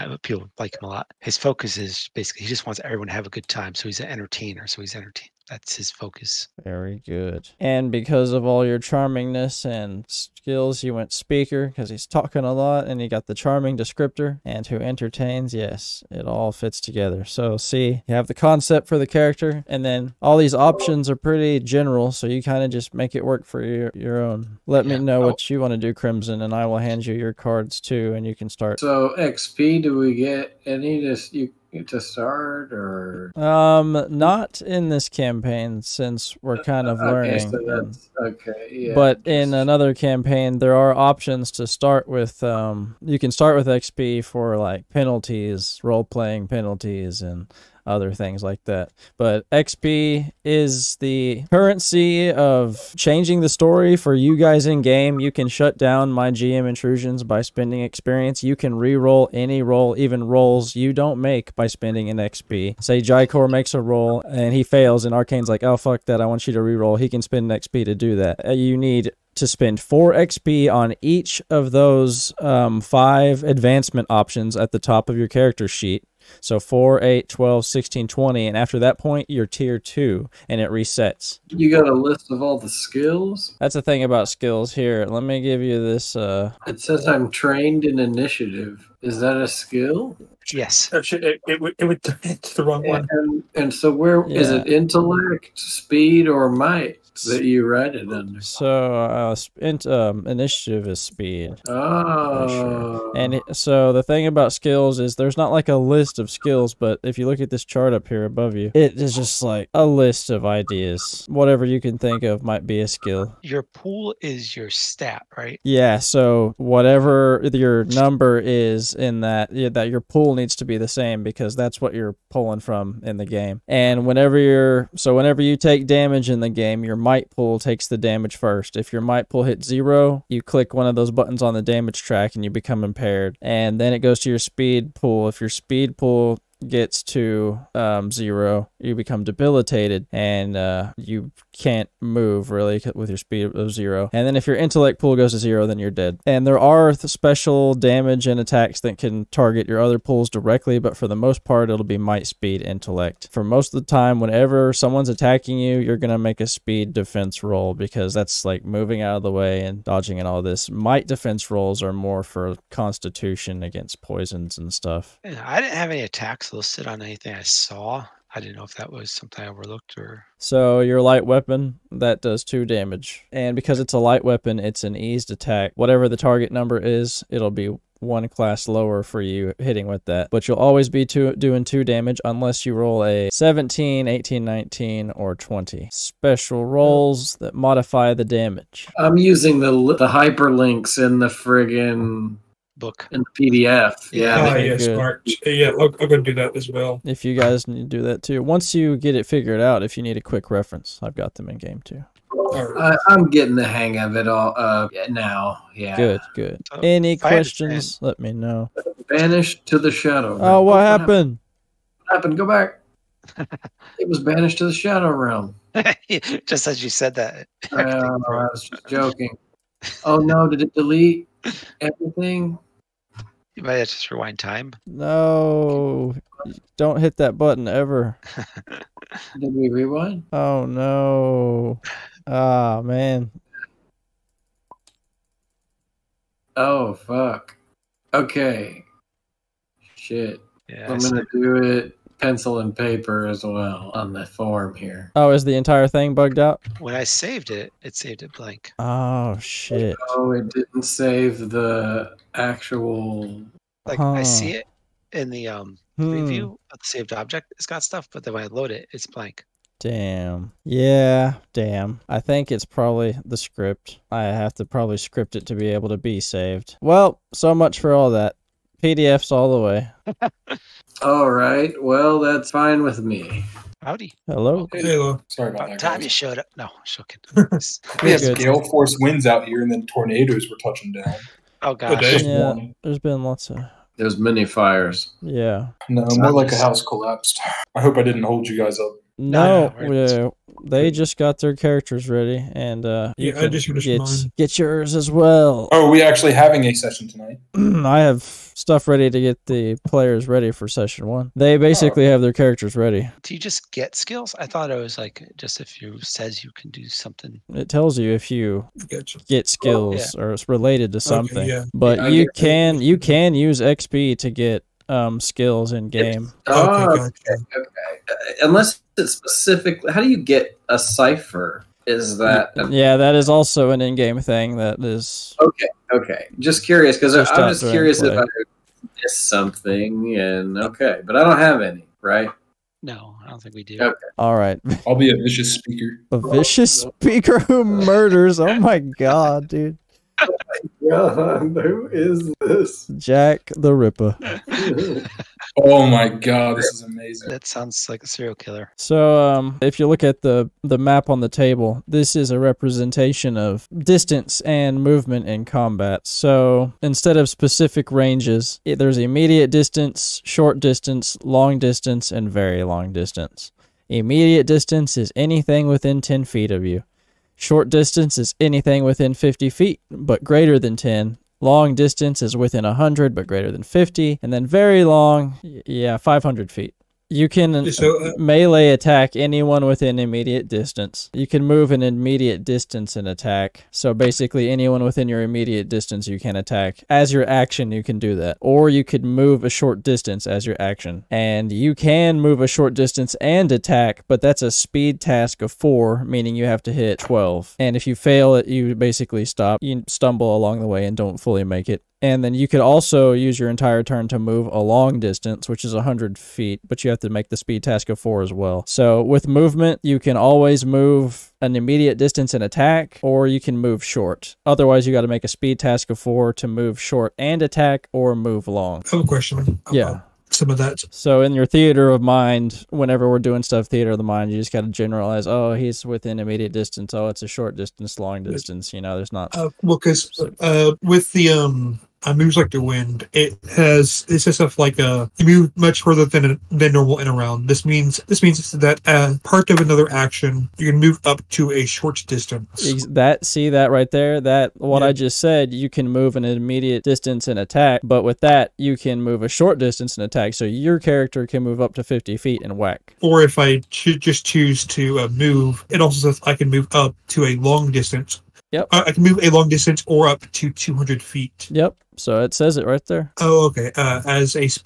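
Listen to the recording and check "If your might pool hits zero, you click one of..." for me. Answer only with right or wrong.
right.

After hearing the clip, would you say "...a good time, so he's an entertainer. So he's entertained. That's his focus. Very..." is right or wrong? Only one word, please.
right.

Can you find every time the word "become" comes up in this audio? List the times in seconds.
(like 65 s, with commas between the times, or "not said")
132 s, 138 s.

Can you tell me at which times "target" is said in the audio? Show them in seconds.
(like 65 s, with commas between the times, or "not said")
149 s, 176 s.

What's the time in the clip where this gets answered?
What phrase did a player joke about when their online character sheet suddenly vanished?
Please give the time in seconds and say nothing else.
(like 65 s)
214 s.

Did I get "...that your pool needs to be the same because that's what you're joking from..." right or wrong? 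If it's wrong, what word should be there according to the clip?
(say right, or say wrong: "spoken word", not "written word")
wrong: "pulling", not "joking".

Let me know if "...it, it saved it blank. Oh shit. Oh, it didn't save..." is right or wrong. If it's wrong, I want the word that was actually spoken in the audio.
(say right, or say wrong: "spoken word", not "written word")
right.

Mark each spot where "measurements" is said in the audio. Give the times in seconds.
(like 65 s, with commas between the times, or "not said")
not said.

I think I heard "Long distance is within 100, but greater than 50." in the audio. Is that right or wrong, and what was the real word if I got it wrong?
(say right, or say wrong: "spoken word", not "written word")
right.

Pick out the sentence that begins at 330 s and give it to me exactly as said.
And okay, but I don't have any, right?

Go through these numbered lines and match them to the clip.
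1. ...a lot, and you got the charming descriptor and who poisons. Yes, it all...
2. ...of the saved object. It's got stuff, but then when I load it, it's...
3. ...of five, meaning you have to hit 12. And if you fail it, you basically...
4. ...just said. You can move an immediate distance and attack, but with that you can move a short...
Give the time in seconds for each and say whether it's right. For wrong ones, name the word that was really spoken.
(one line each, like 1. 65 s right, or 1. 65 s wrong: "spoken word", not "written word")
1. 12 s wrong: "entertains", not "poisons"
2. 256 s right
3. 395 s wrong: "four", not "five"
4. 444 s right.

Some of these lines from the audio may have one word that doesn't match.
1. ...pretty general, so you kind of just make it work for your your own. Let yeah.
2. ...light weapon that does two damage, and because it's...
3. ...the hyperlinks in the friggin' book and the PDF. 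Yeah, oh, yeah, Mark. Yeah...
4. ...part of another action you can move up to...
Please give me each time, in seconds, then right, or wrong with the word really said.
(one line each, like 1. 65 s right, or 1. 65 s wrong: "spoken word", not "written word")
1. 21 s right
2. 171 s right
3. 189 s right
4. 439 s right.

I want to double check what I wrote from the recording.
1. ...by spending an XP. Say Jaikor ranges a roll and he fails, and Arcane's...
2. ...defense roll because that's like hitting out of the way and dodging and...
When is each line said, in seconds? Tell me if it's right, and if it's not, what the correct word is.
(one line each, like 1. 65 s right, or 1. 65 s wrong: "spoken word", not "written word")
1. 61 s wrong: "makes", not "ranges"
2. 156 s wrong: "moving", not "hitting".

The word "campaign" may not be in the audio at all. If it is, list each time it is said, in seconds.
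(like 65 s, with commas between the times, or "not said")
35 s, 39 s.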